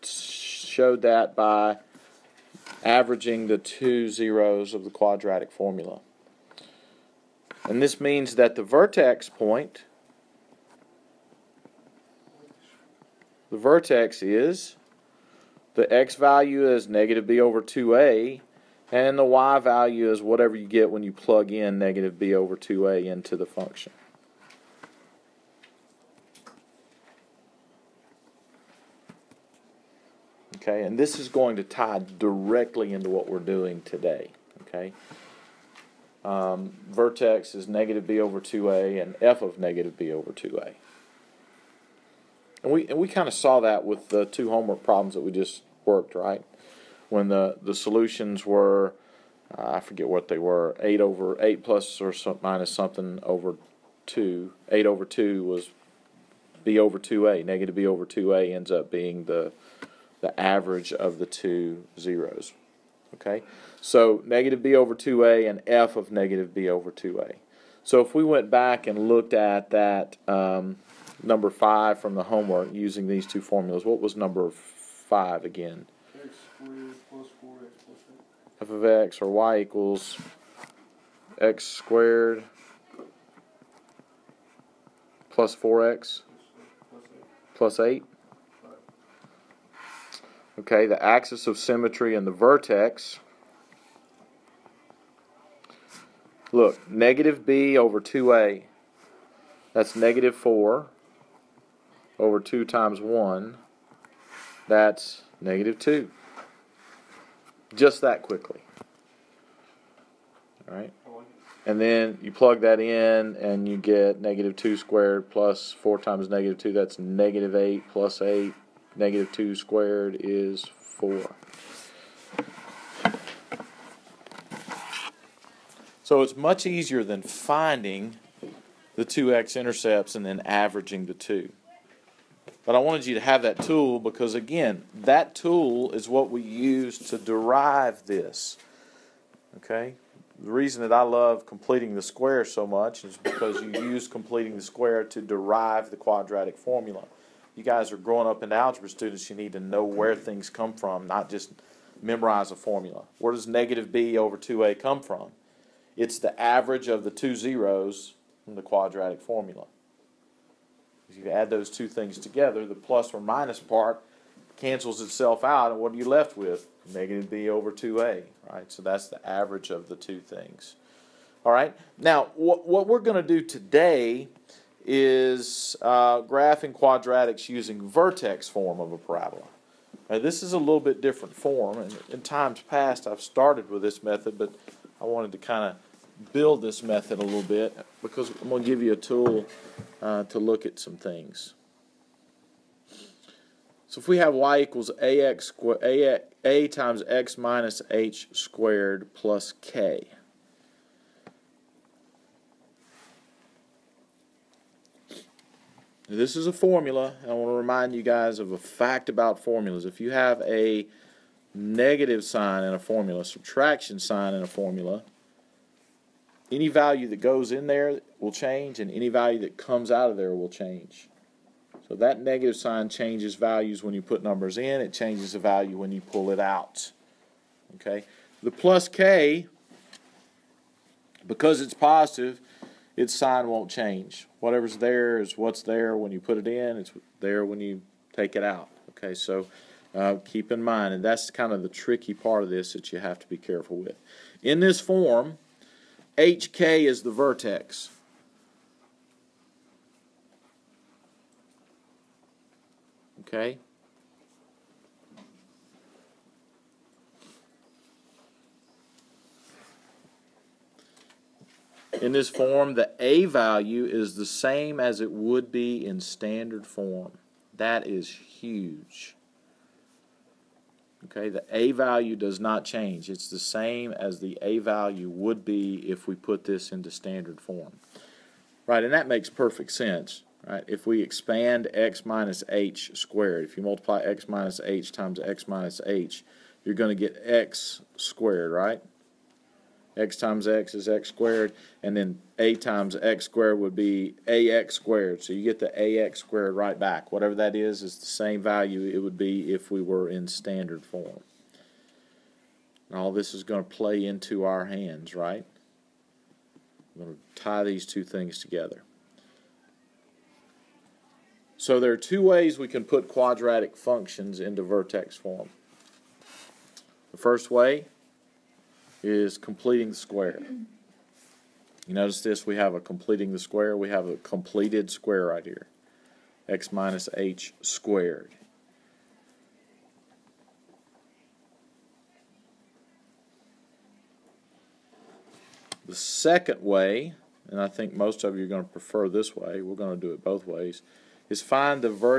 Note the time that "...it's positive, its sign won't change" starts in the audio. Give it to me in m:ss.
3:51.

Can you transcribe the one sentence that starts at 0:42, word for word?
And we and we kind of saw that with the two homework problems that we just worked, right?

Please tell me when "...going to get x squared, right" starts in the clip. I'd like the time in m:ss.
4:46.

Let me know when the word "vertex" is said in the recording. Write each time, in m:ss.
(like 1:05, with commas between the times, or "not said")
0:08, 0:13, 0:36, 1:32, 2:57, 4:07, 5:14.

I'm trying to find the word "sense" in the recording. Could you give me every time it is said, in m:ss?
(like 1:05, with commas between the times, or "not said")
4:39.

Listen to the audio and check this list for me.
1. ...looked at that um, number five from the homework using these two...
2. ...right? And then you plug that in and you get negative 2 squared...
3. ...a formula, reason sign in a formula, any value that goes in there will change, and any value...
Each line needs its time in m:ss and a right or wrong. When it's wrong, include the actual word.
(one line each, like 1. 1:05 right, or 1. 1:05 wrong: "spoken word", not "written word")
1. 1:09 right
2. 1:50 right
3. 3:32 wrong: "subtraction", not "reason".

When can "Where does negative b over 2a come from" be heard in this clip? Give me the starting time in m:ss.
2:33.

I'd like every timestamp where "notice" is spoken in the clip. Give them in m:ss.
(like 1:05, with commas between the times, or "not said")
5:21.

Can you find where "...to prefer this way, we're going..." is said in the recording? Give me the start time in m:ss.
5:38.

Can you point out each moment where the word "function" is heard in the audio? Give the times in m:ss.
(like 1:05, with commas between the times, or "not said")
0:23, 5:13.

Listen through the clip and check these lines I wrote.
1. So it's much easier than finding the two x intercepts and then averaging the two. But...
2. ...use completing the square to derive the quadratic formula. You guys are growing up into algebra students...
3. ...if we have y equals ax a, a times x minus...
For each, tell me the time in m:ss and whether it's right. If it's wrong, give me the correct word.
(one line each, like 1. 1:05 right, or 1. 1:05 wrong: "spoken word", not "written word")
1. 2:06 right
2. 2:23 right
3. 3:13 right.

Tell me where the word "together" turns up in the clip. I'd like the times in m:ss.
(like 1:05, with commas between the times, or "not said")
2:42, 5:08.